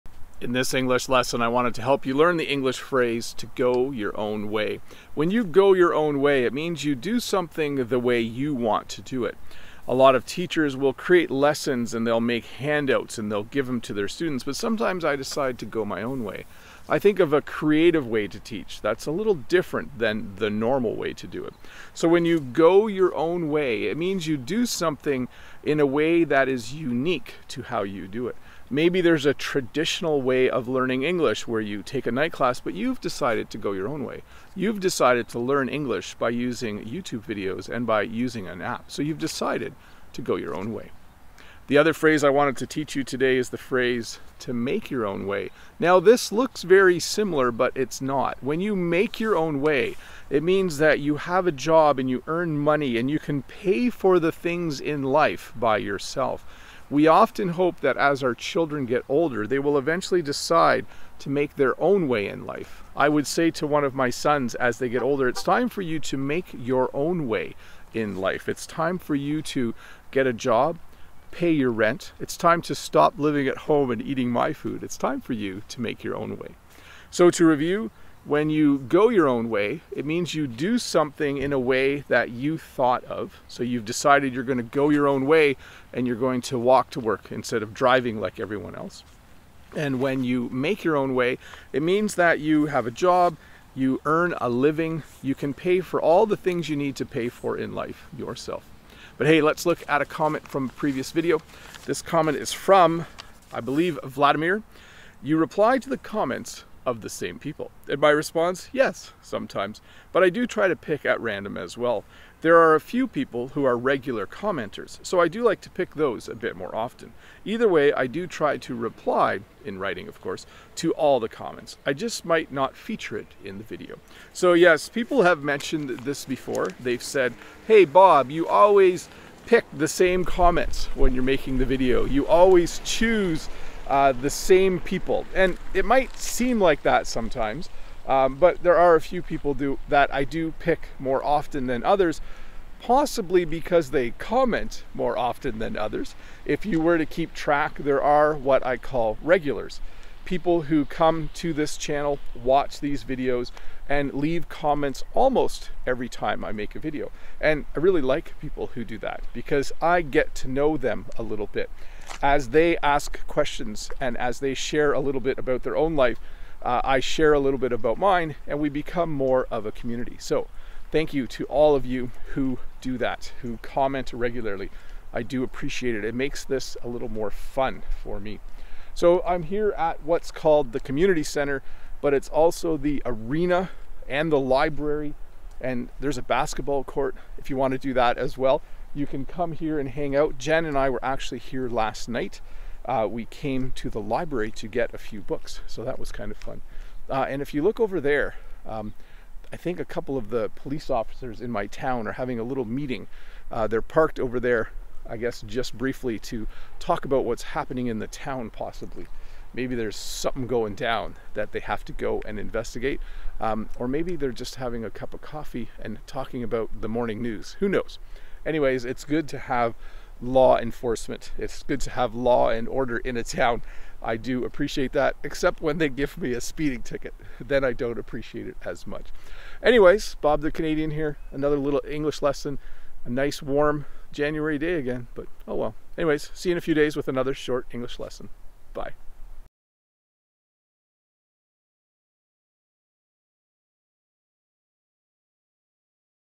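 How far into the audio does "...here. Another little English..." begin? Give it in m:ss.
3:50.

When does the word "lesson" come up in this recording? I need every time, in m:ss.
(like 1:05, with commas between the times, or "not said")
0:01, 0:11, 3:52, 3:57.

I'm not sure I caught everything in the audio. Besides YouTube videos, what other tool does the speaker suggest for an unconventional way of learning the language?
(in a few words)
an app.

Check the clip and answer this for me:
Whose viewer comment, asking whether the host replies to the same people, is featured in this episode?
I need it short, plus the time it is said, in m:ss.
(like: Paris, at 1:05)
Vladimir, at 1:44.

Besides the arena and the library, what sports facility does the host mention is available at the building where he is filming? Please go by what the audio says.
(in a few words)
basketball court.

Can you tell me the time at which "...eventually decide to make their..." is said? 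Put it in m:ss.
0:59.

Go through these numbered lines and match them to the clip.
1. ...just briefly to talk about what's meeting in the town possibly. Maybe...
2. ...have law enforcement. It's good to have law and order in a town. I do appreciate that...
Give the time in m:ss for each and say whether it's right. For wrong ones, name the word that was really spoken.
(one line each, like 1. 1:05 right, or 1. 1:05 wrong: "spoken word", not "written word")
1. 3:25 wrong: "happening", not "meeting"
2. 3:39 right.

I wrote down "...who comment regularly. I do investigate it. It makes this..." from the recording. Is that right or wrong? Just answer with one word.
wrong.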